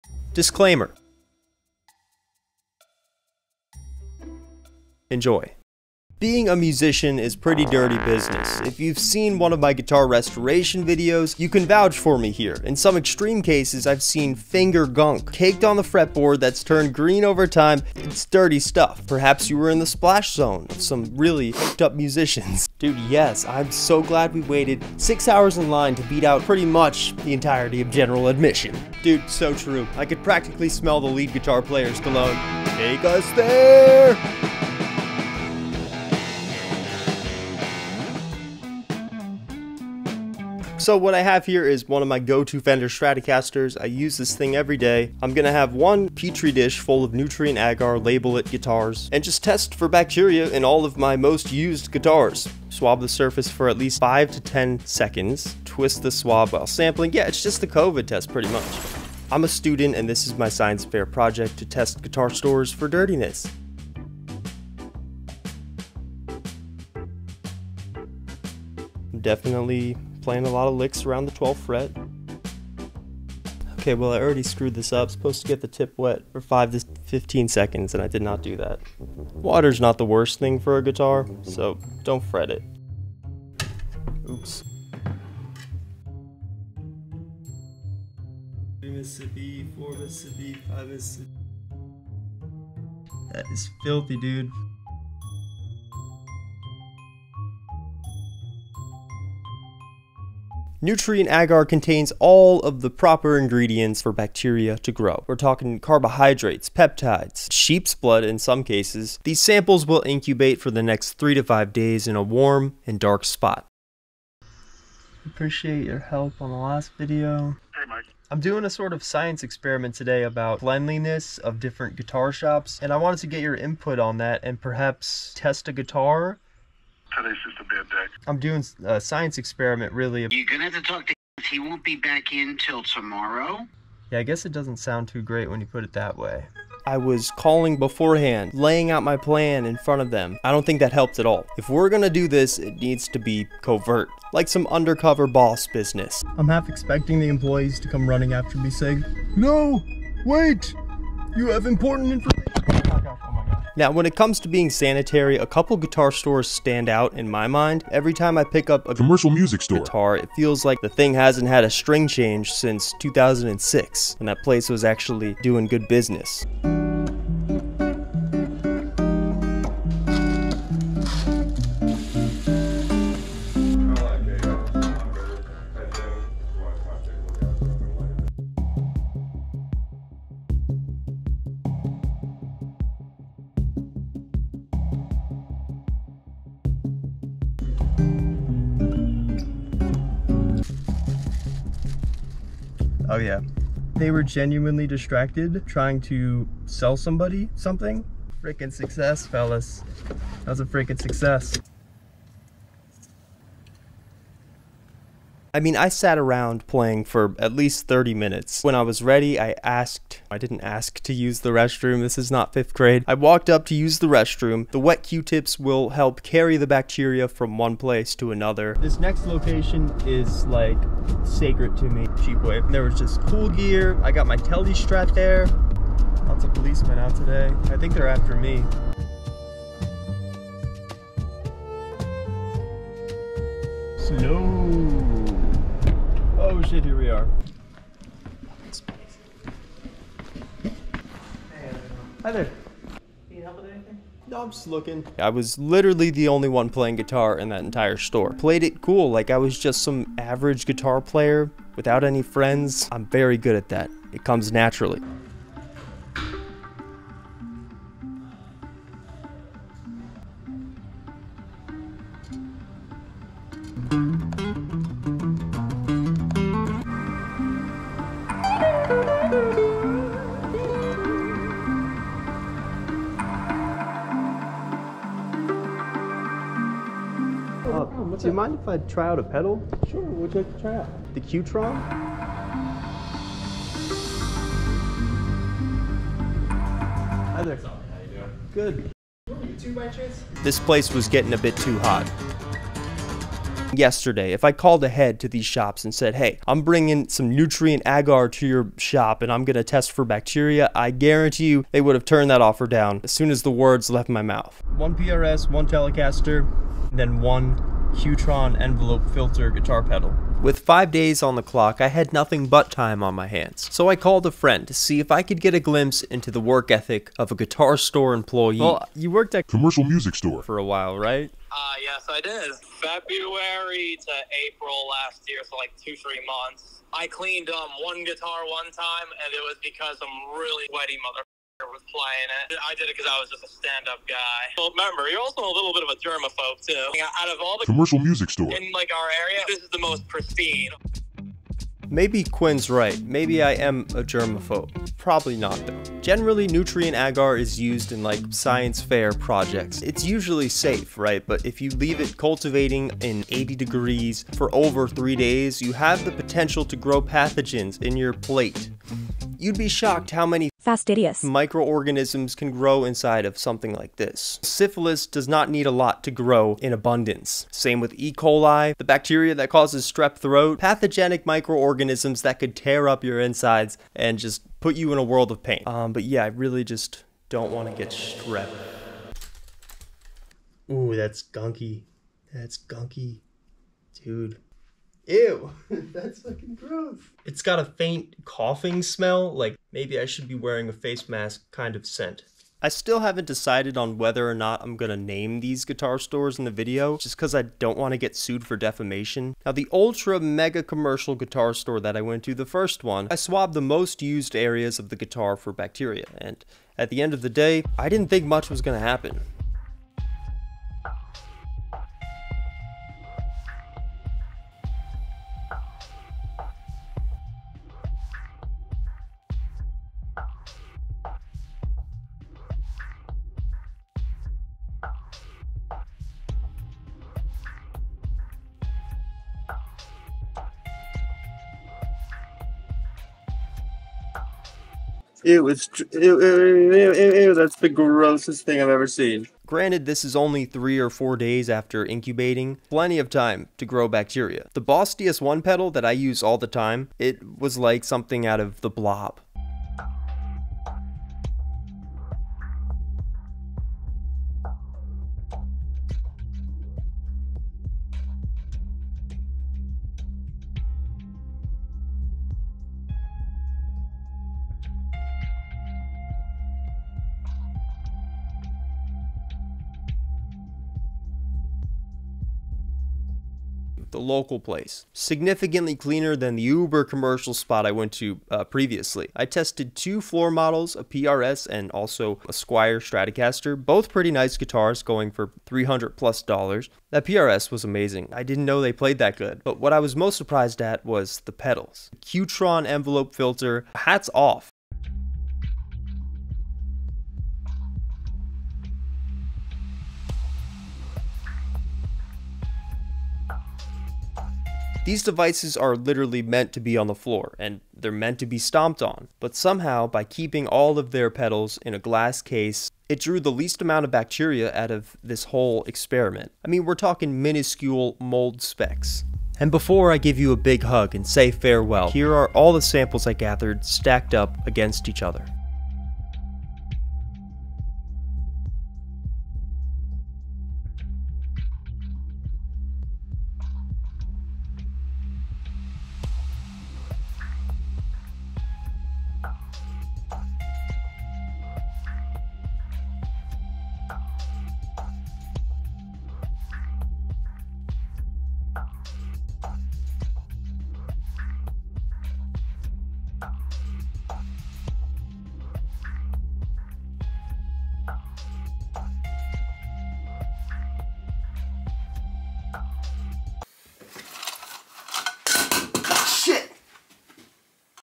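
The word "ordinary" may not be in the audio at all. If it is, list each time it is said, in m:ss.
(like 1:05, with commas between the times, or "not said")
not said.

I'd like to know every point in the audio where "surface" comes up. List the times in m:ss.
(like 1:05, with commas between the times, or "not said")
0:53.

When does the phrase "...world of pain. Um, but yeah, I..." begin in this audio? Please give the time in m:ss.
6:15.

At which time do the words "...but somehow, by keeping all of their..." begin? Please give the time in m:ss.
8:29.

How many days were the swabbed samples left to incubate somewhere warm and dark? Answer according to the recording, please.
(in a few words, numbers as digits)
three to five days.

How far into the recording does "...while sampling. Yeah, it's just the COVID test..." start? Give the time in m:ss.
0:56.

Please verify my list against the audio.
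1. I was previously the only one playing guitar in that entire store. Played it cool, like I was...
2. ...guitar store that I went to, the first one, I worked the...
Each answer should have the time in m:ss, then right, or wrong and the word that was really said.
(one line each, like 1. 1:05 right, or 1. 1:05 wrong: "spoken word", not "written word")
1. 4:05 wrong: "literally", not "previously"
2. 6:41 wrong: "swabbed", not "worked".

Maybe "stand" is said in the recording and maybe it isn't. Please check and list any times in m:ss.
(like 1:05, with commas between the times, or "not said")
2:36, 5:33.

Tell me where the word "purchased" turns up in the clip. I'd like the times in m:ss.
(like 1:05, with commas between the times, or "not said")
not said.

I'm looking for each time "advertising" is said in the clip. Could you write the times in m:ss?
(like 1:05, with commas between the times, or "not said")
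not said.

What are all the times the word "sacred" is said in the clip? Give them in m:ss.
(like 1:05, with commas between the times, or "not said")
3:41.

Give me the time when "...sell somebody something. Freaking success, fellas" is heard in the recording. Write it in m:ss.
3:16.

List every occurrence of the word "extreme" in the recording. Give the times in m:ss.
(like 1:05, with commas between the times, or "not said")
0:12.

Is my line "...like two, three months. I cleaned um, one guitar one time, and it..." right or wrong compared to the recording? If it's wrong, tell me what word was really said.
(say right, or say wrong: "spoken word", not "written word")
right.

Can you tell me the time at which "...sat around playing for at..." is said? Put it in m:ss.
3:25.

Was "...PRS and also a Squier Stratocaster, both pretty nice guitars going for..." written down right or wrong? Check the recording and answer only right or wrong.
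right.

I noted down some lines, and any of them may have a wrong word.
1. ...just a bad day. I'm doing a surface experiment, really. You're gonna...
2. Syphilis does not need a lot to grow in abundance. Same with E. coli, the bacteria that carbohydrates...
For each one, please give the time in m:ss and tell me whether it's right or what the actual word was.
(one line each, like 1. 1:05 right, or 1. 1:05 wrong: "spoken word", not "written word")
1. 2:07 wrong: "science", not "surface"
2. 6:04 wrong: "causes", not "carbohydrates".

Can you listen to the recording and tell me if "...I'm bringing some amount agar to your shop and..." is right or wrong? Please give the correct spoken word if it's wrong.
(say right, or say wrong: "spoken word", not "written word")
wrong: "nutrient", not "amount".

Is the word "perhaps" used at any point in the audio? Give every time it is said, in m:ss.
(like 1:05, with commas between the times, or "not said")
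0:19, 2:04.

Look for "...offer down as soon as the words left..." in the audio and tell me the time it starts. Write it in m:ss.
5:02.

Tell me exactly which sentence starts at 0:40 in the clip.
So what I have here is one of my go-to Fender Stratocasters.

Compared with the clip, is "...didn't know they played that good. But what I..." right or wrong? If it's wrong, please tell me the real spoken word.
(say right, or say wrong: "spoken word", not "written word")
right.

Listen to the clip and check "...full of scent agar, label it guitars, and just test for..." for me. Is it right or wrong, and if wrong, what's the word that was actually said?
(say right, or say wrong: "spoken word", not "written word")
wrong: "nutrient", not "scent".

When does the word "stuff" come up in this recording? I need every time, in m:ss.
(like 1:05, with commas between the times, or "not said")
0:18.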